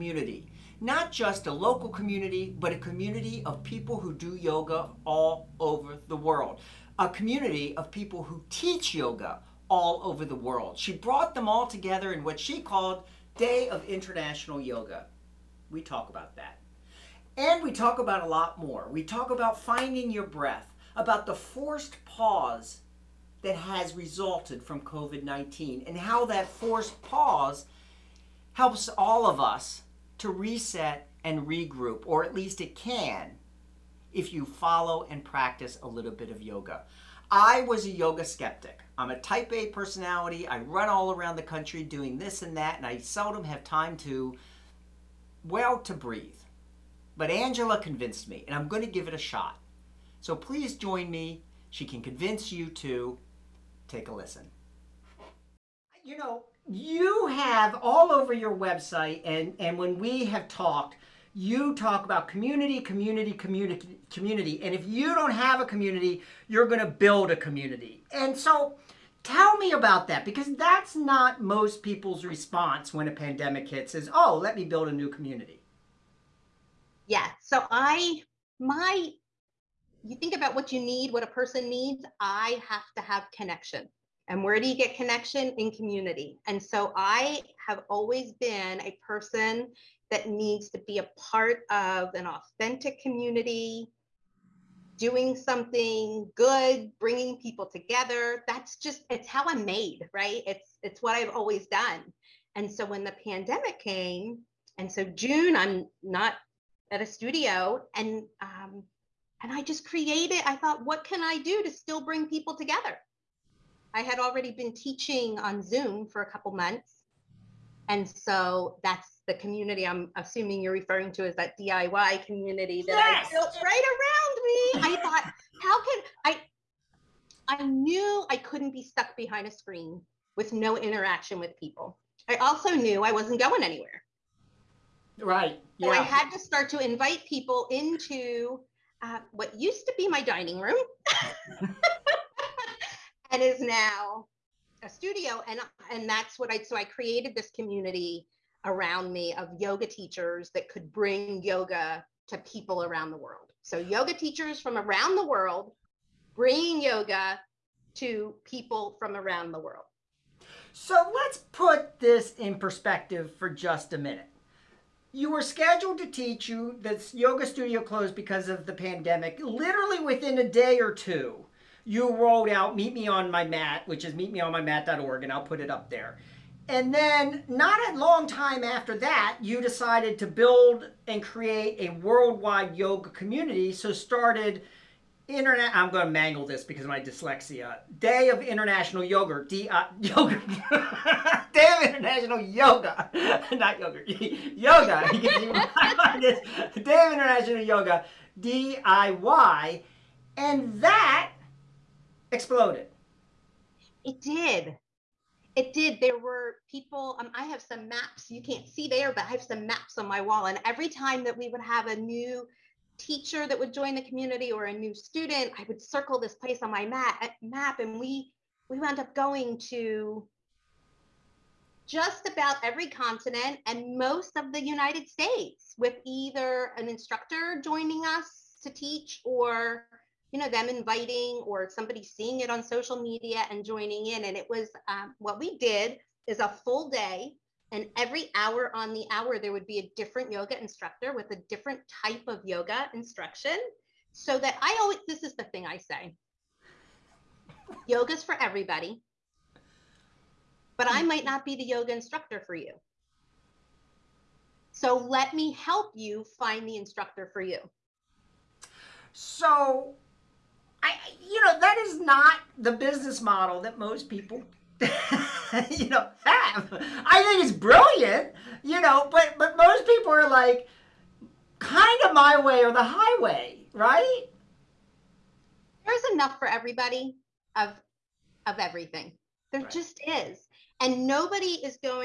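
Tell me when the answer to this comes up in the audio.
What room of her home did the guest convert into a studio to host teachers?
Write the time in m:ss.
2:20.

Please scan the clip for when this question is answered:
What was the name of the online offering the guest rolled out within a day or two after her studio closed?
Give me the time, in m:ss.
2:52.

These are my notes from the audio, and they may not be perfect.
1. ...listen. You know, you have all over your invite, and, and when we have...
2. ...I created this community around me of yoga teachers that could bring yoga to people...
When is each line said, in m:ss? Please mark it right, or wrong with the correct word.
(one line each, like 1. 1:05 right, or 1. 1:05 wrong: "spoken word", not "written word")
1. 0:54 wrong: "website", not "invite"
2. 2:26 right.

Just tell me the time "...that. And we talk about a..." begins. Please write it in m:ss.
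0:16.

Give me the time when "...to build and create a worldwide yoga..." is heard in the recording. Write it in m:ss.
3:00.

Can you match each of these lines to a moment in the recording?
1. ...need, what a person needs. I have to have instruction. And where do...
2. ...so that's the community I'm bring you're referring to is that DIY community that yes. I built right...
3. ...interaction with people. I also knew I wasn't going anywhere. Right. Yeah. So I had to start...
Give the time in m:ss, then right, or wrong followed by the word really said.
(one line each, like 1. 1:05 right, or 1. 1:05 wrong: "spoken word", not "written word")
1. 1:20 wrong: "connection", not "instruction"
2. 1:58 wrong: "assuming", not "bring"
3. 2:10 right.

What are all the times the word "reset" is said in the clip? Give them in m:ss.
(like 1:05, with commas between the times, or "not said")
0:30.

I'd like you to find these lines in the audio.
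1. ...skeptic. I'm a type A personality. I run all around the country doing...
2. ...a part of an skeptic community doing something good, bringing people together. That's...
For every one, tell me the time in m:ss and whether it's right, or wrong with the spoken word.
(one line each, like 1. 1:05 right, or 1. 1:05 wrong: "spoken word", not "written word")
1. 0:38 right
2. 1:30 wrong: "authentic", not "skeptic".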